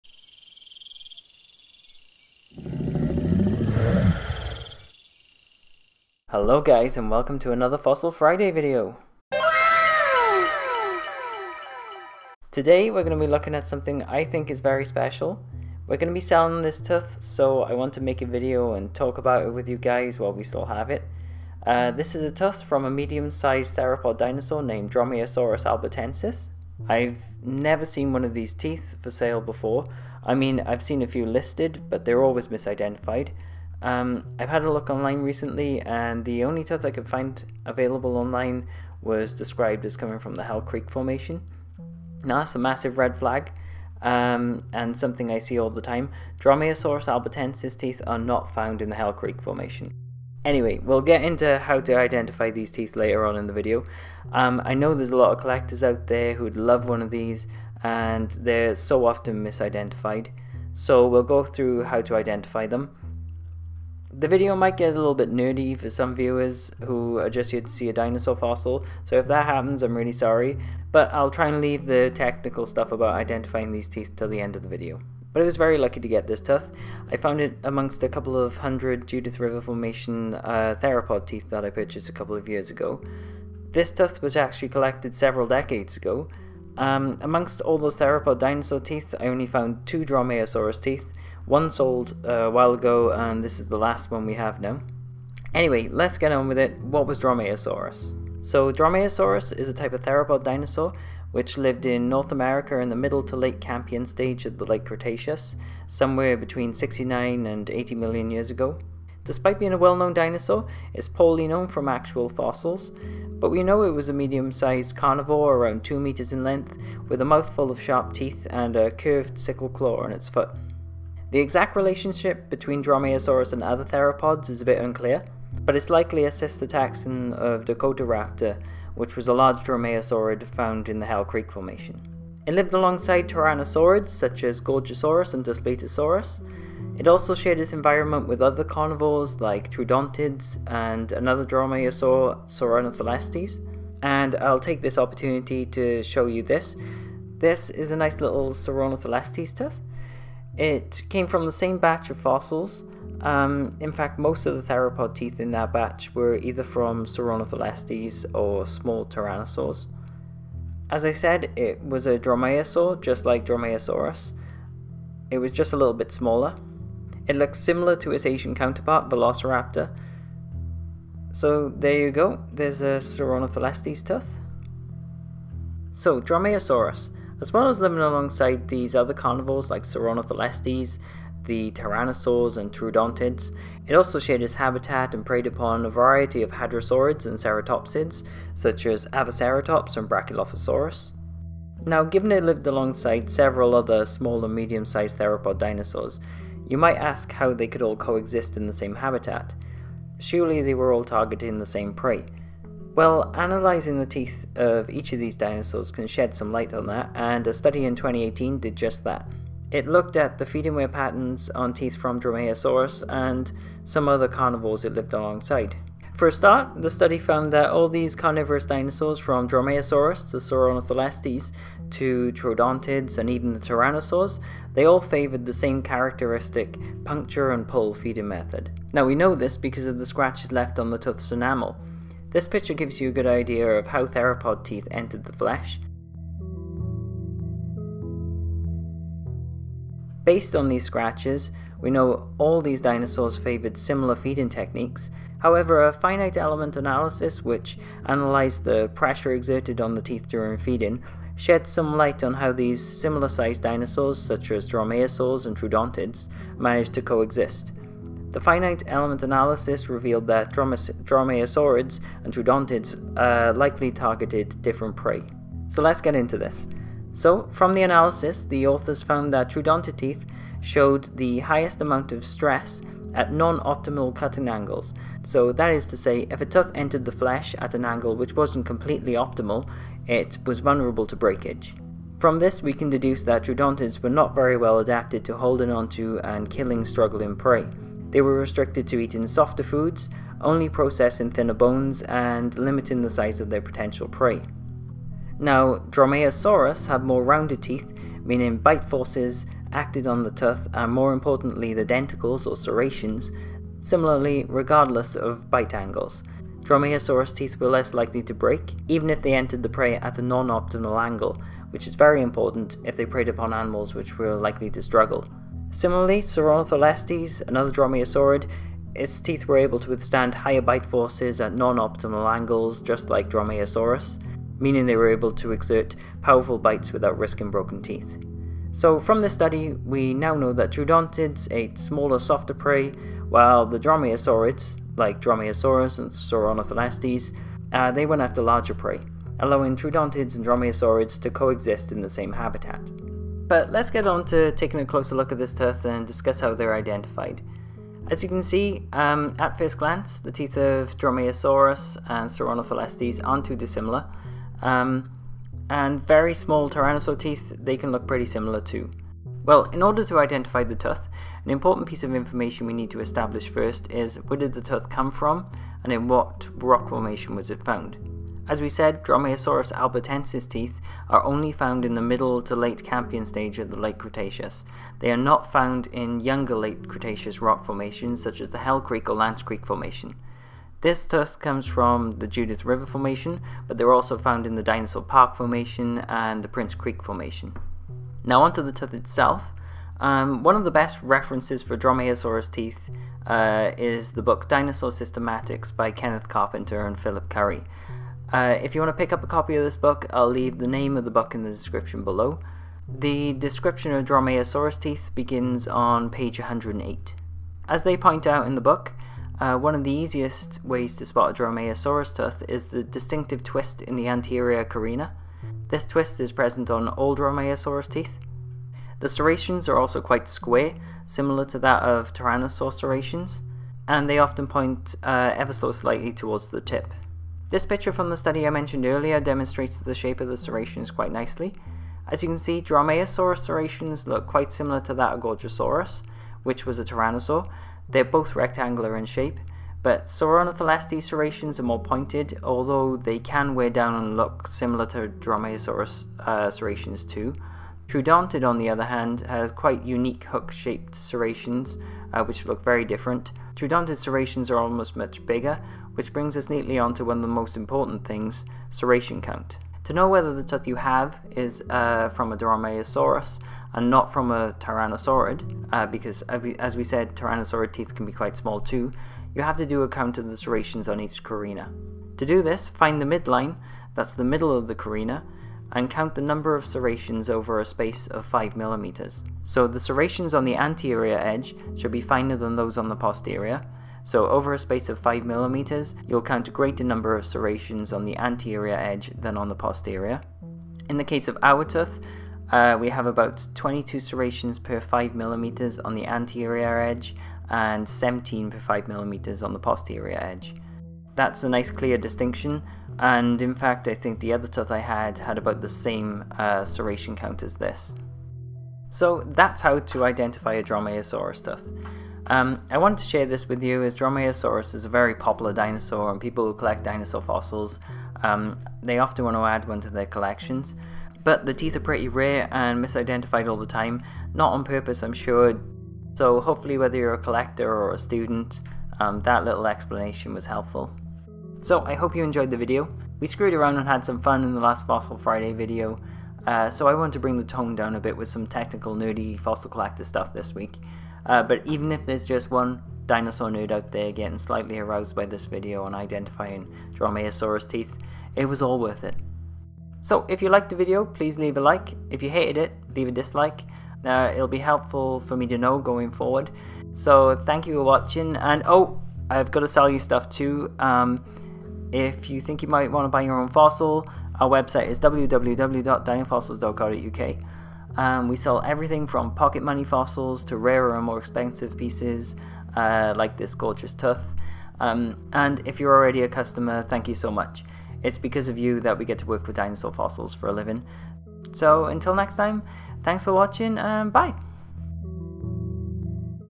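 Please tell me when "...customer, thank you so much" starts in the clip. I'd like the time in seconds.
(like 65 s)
576 s.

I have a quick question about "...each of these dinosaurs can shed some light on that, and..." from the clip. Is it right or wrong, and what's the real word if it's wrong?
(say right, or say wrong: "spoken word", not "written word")
right.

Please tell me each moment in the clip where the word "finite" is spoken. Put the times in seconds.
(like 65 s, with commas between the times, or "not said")
245 s, 258 s.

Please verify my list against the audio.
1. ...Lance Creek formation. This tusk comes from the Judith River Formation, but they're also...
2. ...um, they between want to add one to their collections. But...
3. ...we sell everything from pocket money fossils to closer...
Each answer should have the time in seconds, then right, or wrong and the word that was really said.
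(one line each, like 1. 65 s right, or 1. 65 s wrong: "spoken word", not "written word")
1. 379 s right
2. 518 s wrong: "often", not "between"
3. 568 s wrong: "rarer", not "closer".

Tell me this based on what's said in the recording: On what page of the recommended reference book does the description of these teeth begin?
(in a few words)
108.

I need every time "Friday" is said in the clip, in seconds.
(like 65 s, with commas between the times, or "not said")
8 s, 535 s.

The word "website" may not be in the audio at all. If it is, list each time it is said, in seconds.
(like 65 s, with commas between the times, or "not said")
564 s.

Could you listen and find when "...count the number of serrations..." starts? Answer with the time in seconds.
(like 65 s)
475 s.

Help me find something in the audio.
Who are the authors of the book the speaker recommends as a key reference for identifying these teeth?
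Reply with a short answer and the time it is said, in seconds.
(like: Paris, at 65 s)
Kenneth Carpenter and Philip Currie, at 395 s.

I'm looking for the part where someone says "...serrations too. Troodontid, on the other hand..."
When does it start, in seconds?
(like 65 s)
446 s.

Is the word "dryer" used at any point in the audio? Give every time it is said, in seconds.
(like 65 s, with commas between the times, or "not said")
not said.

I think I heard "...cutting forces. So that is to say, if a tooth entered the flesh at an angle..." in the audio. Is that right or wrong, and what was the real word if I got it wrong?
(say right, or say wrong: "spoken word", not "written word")
wrong: "angles", not "forces".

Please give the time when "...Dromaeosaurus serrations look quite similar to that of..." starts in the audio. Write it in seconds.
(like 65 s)
432 s.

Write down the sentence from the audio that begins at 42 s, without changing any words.
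Now, that's a massive red flag, um, and something I see all the time.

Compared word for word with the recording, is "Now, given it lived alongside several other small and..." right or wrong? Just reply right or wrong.
right.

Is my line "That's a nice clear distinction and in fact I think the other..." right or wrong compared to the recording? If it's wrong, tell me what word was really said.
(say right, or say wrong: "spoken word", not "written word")
right.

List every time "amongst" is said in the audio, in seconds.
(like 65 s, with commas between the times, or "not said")
77 s, 87 s.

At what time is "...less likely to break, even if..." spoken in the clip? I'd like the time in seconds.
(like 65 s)
307 s.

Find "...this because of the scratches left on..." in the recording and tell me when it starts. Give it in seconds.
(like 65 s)
229 s.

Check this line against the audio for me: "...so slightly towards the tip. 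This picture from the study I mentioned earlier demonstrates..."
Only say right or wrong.
right.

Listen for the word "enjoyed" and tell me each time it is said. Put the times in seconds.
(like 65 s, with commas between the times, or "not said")
532 s.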